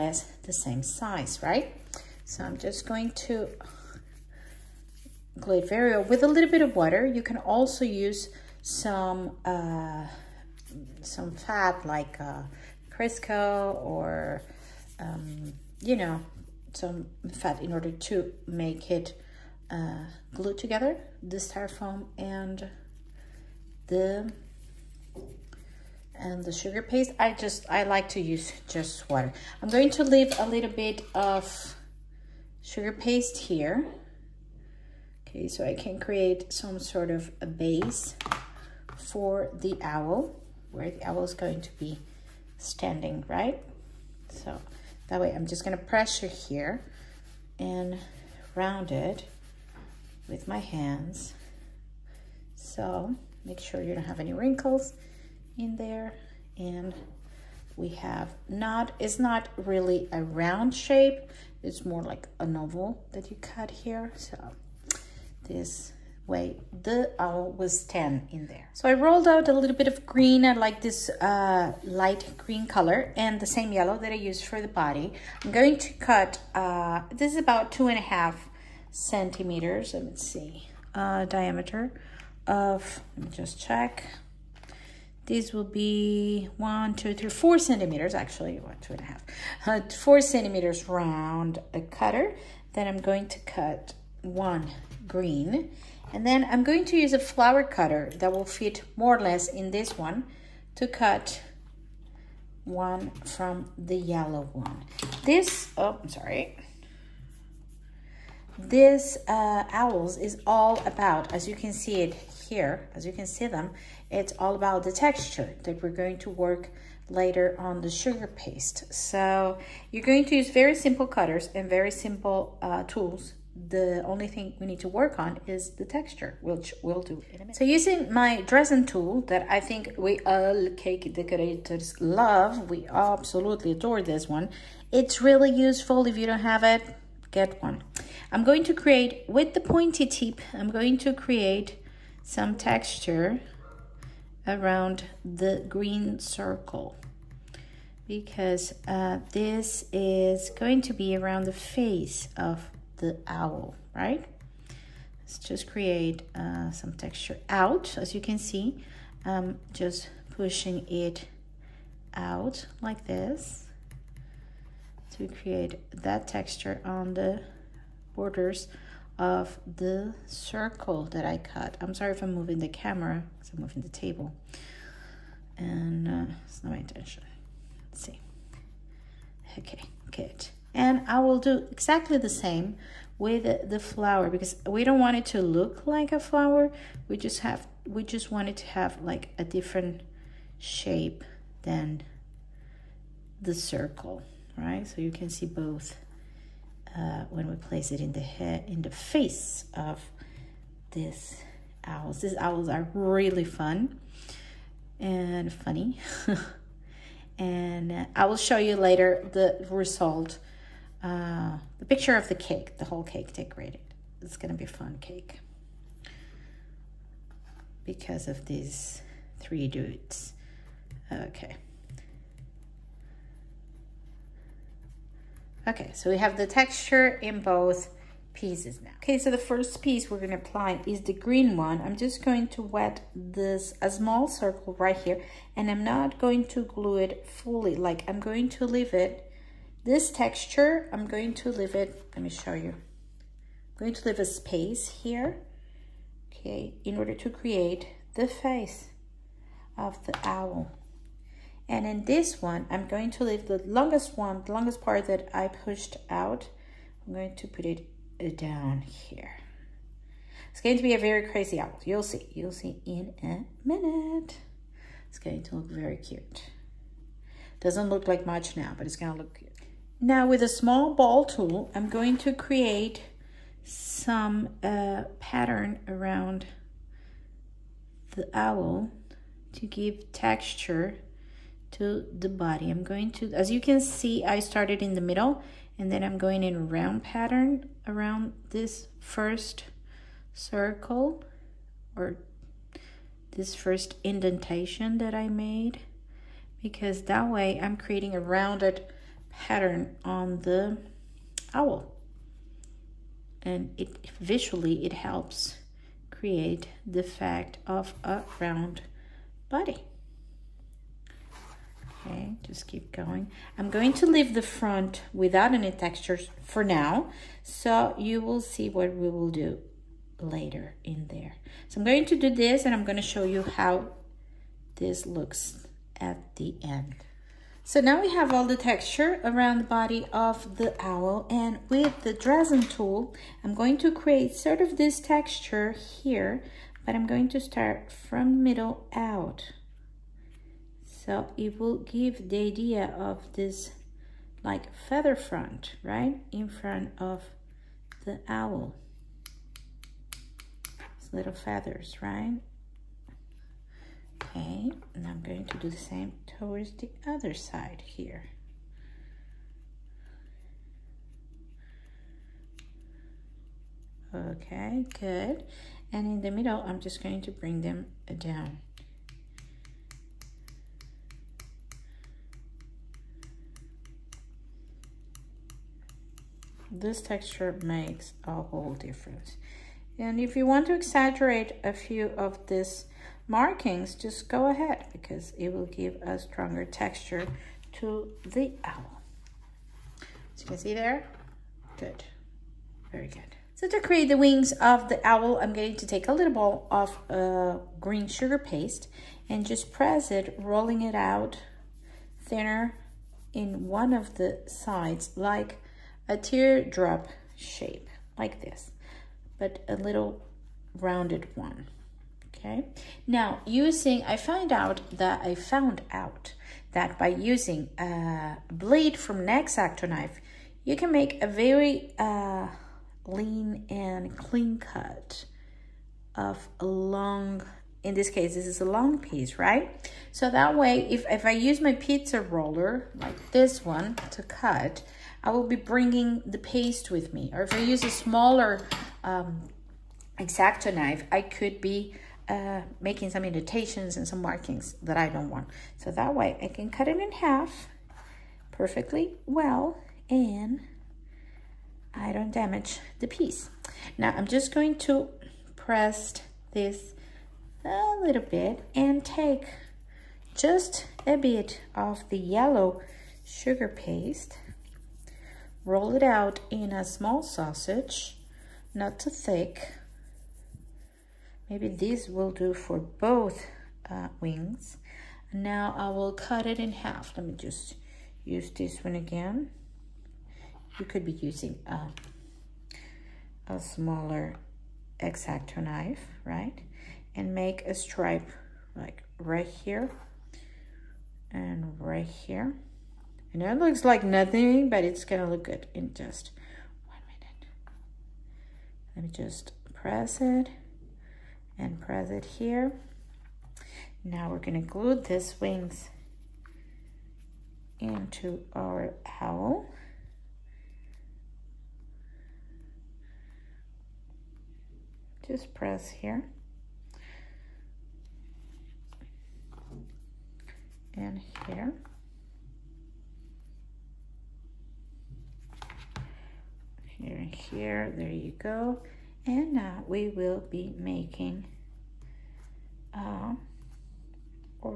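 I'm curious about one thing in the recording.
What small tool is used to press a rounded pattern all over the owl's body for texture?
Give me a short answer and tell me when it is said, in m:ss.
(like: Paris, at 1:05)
Ball tool, at 4:30.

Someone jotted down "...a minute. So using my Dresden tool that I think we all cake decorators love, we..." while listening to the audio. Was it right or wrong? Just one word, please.
right.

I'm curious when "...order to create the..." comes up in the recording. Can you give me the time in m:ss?
4:06.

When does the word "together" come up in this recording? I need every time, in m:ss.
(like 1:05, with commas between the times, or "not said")
0:20.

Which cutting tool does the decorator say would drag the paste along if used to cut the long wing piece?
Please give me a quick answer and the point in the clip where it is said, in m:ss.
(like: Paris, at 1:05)
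Pizza roller, at 7:11.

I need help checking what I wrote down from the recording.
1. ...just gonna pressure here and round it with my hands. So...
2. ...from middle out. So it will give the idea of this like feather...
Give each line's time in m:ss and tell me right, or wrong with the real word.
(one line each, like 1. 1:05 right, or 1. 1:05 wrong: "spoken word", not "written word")
1. 0:45 right
2. 5:37 right.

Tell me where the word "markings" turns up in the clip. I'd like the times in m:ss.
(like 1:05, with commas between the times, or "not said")
6:23, 7:24.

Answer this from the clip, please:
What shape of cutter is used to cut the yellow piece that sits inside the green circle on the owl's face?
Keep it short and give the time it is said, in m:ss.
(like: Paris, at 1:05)
Flower cutter, at 1:37.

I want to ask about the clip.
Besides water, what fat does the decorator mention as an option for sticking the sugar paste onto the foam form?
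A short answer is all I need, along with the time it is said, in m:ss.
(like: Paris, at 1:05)
Crisco, at 0:12.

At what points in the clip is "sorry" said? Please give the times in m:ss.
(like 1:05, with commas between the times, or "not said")
1:46, 2:51.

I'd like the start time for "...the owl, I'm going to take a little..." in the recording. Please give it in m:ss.
6:34.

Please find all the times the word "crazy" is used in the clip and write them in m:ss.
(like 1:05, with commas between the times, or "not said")
4:21.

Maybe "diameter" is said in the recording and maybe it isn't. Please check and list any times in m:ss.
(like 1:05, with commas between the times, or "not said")
1:21.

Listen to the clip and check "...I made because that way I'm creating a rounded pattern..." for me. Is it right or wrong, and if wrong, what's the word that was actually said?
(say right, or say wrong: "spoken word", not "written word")
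right.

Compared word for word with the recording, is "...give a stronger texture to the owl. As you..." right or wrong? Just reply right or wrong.
right.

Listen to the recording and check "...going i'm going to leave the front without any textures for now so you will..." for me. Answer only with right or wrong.
right.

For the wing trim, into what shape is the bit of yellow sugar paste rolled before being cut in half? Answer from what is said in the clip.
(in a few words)
Small sausage.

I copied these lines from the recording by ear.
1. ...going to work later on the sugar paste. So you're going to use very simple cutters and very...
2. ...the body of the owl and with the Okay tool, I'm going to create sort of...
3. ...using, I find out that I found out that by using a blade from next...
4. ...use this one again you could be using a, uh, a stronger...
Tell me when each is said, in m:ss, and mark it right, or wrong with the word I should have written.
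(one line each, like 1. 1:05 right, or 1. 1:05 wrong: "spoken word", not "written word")
1. 1:55 right
2. 5:29 wrong: "Dresden", not "Okay"
3. 6:53 right
4. 7:58 wrong: "smaller", not "stronger".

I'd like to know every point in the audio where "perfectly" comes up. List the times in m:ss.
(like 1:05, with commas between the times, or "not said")
7:28.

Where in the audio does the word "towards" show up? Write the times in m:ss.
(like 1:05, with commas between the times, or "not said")
5:56.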